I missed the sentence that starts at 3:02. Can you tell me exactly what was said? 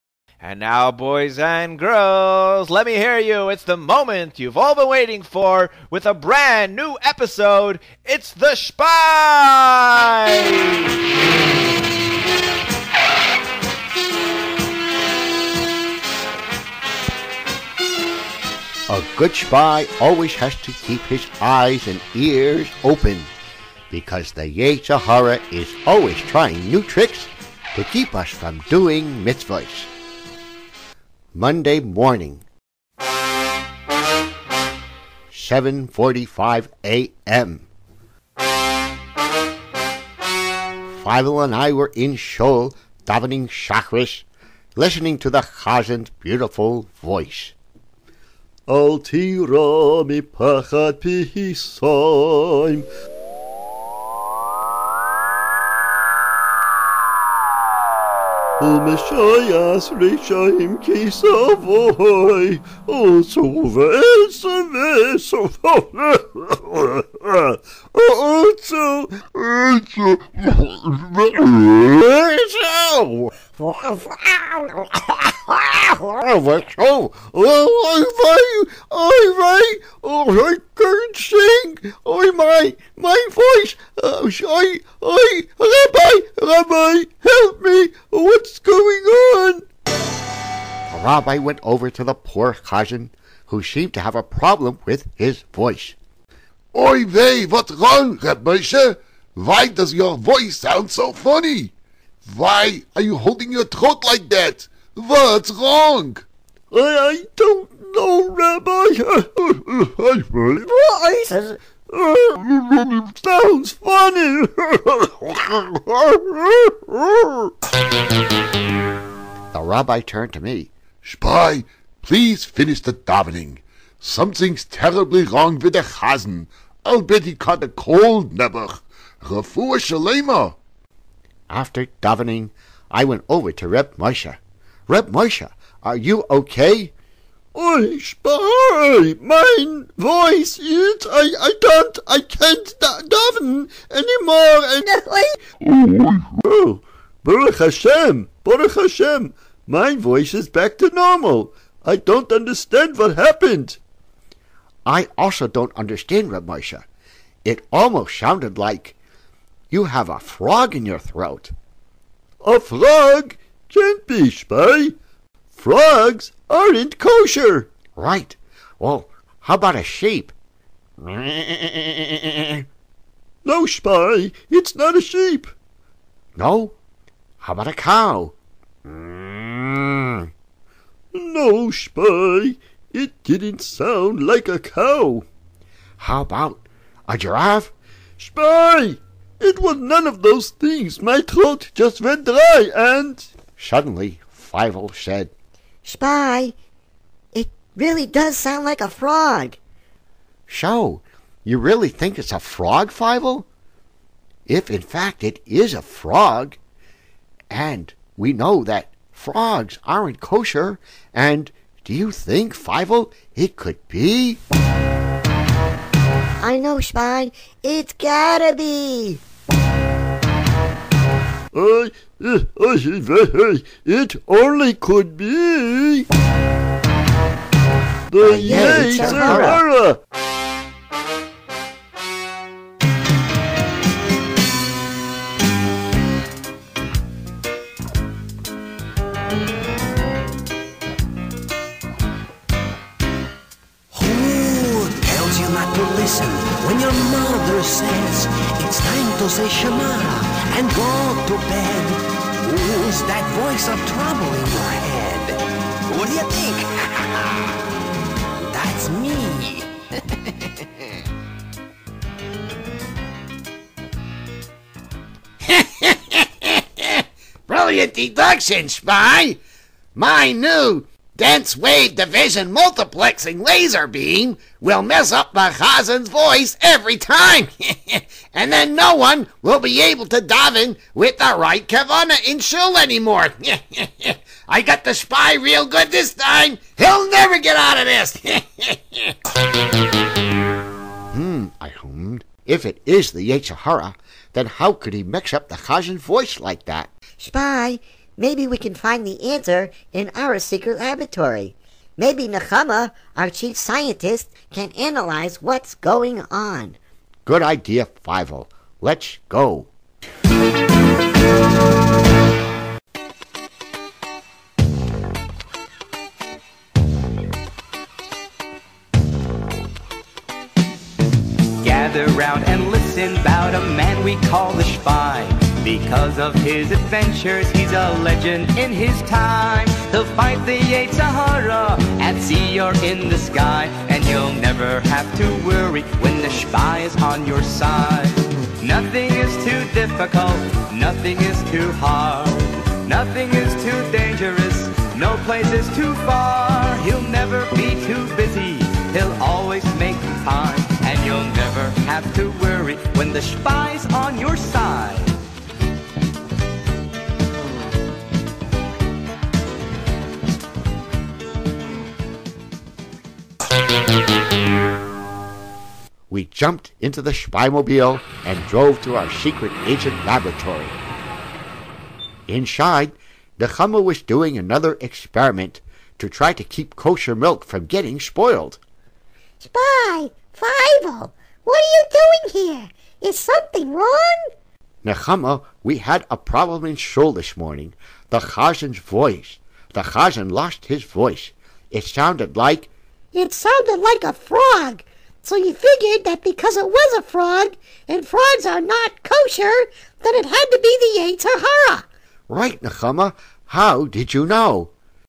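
It didn't sound like a cow.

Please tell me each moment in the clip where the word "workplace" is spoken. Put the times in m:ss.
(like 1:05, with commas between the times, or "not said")
not said.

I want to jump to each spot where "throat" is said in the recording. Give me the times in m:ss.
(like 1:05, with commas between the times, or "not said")
1:43, 2:40, 3:11.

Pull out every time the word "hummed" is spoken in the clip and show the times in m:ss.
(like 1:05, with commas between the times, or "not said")
4:51.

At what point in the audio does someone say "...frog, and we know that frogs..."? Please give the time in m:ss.
3:25.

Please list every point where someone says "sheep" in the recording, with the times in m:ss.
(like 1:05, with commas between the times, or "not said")
2:49, 2:55.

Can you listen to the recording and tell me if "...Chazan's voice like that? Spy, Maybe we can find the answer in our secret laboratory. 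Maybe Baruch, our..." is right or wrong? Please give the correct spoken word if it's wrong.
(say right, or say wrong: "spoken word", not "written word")
wrong: "Nechama", not "Baruch".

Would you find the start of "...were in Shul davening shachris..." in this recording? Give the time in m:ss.
0:41.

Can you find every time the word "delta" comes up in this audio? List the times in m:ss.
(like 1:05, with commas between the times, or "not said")
not said.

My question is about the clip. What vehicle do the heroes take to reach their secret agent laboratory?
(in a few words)
Spymobile.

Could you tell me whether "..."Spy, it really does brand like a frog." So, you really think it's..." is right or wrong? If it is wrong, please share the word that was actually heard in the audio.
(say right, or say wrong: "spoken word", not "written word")
wrong: "sound", not "brand".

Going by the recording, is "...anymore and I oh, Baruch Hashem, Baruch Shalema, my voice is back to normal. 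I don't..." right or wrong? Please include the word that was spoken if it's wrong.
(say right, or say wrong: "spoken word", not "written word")
wrong: "Hashem", not "Shalema".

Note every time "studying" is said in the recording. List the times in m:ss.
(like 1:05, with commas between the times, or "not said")
not said.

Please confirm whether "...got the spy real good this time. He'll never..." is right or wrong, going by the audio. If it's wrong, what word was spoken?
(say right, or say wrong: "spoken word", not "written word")
right.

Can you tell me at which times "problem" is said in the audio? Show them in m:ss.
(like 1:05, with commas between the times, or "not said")
1:34, 6:26.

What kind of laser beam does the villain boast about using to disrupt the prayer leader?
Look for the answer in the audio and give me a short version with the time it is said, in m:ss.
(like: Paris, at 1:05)
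dense wave division multiplexing, at 4:31.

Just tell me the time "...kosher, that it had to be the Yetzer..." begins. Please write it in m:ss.
6:39.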